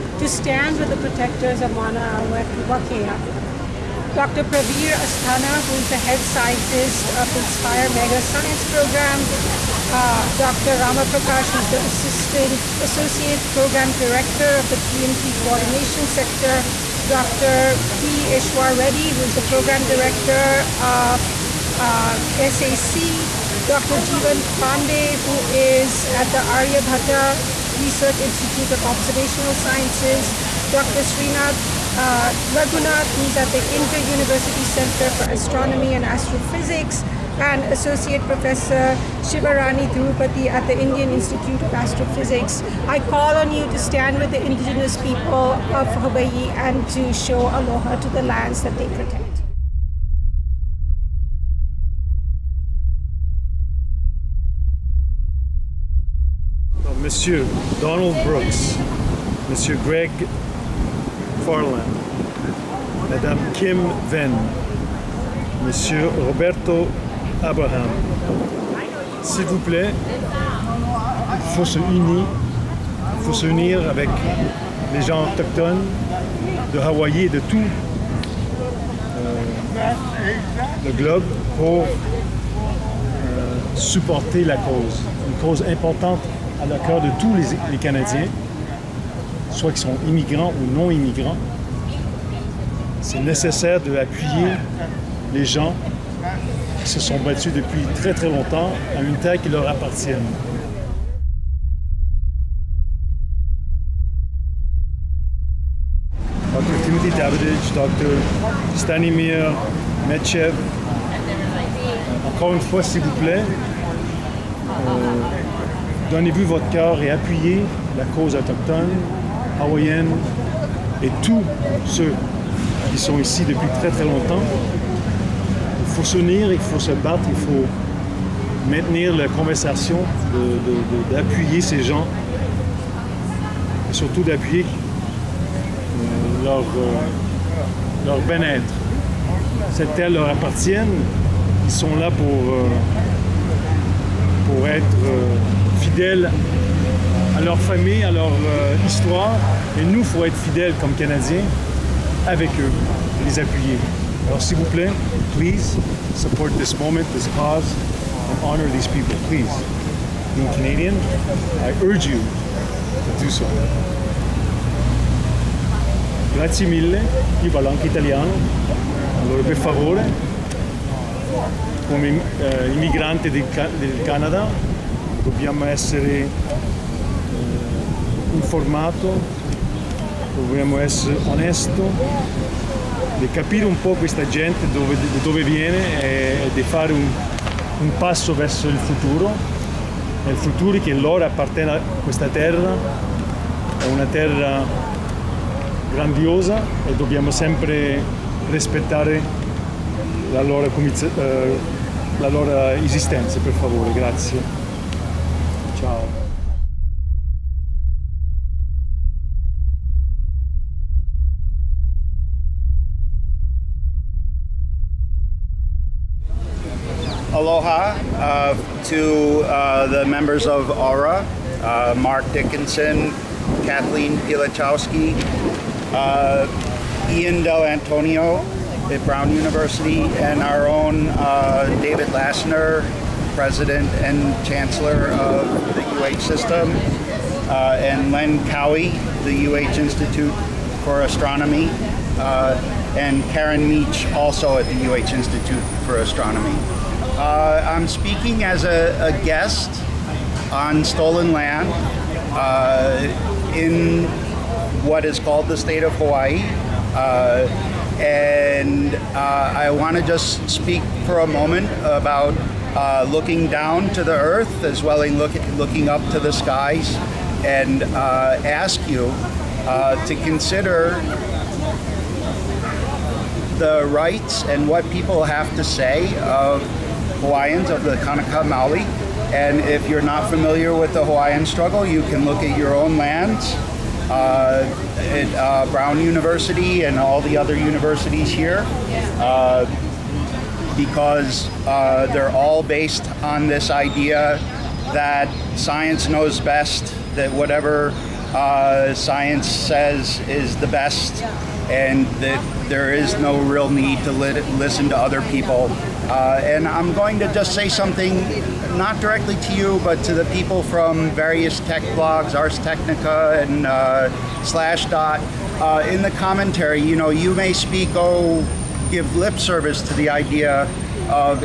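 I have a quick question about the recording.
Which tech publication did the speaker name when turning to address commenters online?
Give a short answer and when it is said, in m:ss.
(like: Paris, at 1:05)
Ars Technica, at 5:12.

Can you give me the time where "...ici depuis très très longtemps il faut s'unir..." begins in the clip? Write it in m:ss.
2:03.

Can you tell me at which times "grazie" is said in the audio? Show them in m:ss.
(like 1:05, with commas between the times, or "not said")
2:46, 3:23.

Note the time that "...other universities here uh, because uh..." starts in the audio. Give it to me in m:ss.
4:47.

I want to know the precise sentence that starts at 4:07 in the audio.
Uh, I'm speaking as a, a, guest on stolen land uh, in what is called the state of Hawaii.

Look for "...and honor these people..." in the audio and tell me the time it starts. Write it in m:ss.
2:38.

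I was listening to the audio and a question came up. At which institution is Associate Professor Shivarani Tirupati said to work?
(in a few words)
Indian Institute of Astrophysics.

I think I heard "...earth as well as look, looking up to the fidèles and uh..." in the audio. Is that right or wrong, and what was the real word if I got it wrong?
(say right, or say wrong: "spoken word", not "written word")
wrong: "skies", not "fidèles".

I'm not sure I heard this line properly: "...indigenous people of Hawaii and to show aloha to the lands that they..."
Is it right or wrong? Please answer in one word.
right.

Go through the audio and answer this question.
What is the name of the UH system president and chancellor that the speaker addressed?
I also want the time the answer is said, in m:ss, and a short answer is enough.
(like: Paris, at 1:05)
David Lassner, at 3:51.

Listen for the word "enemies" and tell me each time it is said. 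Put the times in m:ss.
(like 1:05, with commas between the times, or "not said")
not said.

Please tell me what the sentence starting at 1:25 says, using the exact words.
Une cause importante à la cœur de tous les, Canadiens, soit qu'ils sont immigrants ou non immigrants.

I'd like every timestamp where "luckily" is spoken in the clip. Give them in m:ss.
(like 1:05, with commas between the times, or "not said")
not said.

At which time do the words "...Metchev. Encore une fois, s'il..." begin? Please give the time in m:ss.
1:50.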